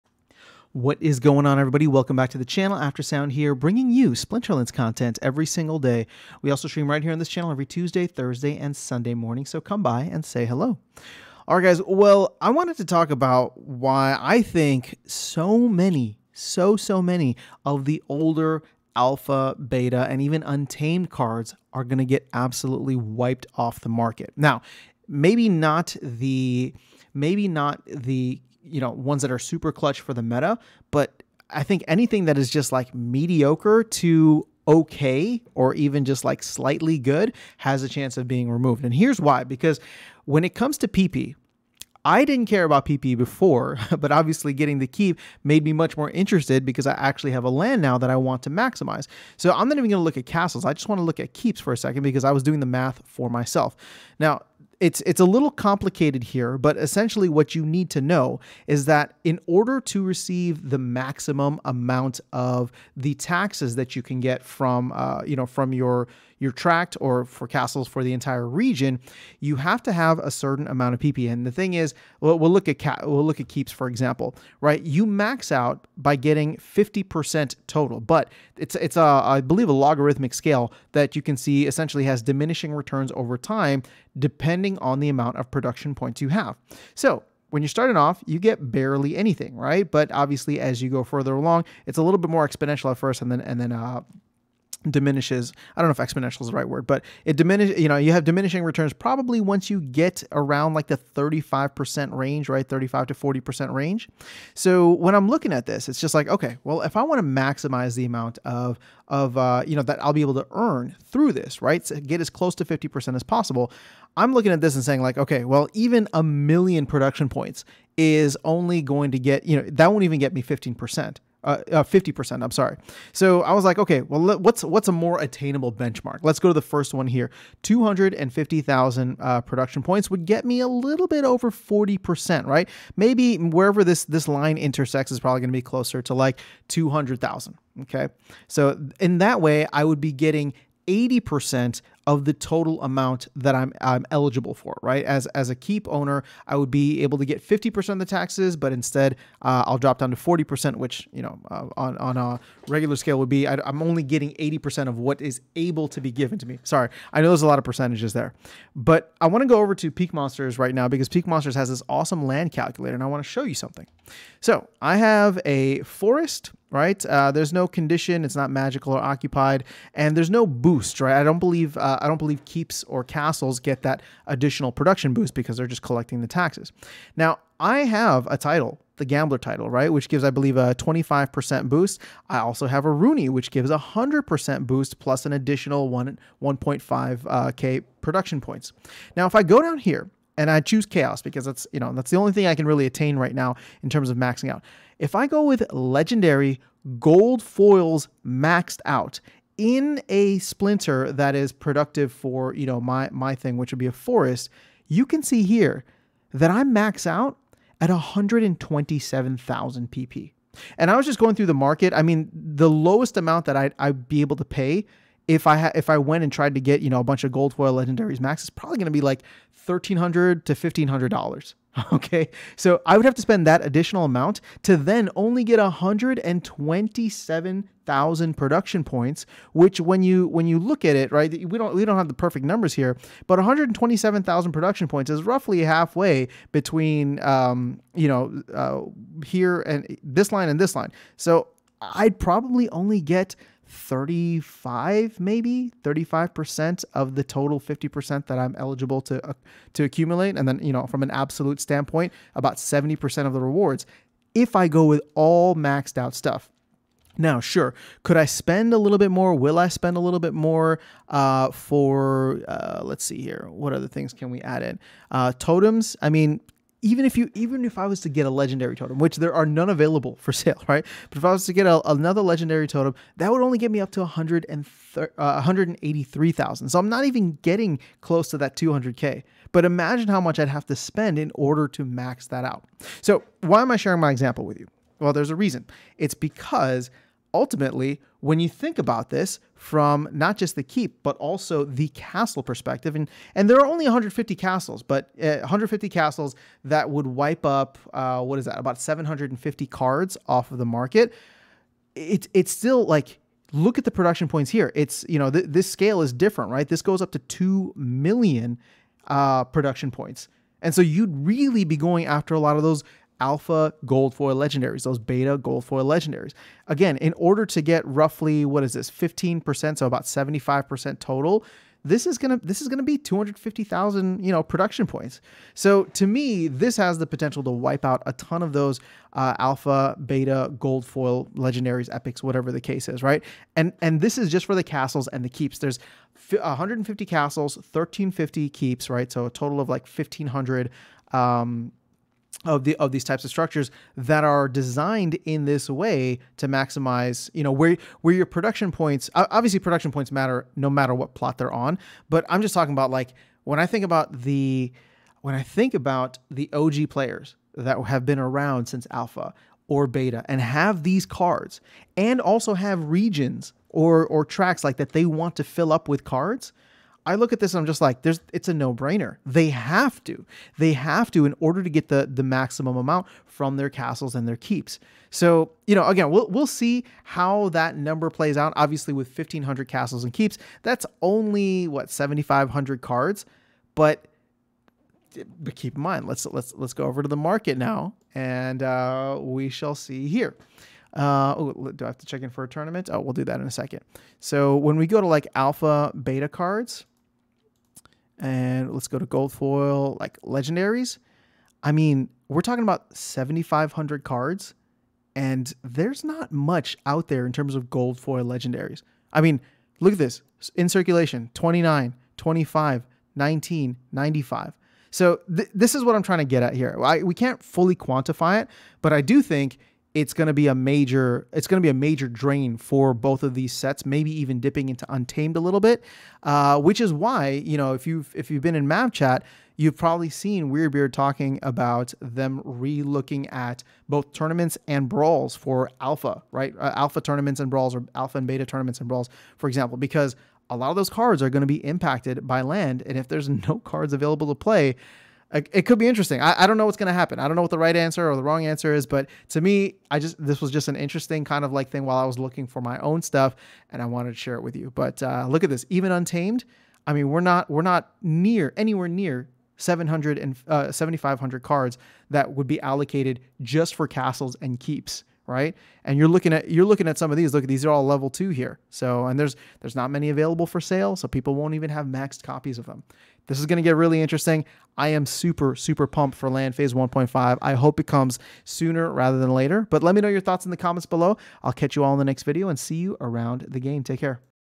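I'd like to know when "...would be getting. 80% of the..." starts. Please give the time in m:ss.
2:19.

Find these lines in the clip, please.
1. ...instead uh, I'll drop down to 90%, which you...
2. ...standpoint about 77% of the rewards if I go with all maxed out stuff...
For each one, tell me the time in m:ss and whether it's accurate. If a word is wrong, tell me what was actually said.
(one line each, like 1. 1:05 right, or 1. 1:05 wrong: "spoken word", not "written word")
1. 2:28 wrong: "40", not "90"
2. 4:11 wrong: "70", not "77".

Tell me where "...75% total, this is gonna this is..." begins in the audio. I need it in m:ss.
5:20.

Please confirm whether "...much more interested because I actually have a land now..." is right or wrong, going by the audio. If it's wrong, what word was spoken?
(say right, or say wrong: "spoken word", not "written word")
right.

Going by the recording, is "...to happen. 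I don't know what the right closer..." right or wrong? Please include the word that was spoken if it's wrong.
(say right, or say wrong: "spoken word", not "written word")
wrong: "answer", not "closer".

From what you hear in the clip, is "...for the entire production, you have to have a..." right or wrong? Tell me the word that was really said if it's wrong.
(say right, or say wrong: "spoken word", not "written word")
wrong: "region", not "production".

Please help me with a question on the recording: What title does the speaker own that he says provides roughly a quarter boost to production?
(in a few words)
the gambler.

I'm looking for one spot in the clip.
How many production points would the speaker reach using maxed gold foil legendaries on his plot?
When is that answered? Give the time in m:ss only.
3:27.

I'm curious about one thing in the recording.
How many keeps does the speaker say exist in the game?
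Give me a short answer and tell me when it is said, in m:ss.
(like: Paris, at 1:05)
1350, at 5:37.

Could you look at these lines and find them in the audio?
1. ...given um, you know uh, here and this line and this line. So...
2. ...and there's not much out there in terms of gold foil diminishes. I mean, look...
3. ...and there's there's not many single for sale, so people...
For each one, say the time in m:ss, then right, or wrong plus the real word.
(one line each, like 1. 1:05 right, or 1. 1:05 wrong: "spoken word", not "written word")
1. 3:56 wrong: "between", not "given"
2. 6:45 wrong: "legendaries", not "diminishes"
3. 7:49 wrong: "available", not "single".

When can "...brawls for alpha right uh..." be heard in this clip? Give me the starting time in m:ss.
7:14.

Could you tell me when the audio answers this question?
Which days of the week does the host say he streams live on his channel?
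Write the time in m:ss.
0:07.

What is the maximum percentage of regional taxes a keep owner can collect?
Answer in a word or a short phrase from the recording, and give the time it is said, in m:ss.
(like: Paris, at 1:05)
50%, at 1:16.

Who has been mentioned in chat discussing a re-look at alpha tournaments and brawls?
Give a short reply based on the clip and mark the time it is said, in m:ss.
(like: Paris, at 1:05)
weirdbeard, at 7:10.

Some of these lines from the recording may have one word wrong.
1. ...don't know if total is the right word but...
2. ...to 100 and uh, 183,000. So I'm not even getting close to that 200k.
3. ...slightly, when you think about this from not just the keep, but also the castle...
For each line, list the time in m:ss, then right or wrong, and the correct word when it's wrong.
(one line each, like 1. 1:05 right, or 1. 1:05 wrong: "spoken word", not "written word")
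1. 1:35 wrong: "exponential", not "total"
2. 4:33 right
3. 4:47 wrong: "ultimately", not "slightly".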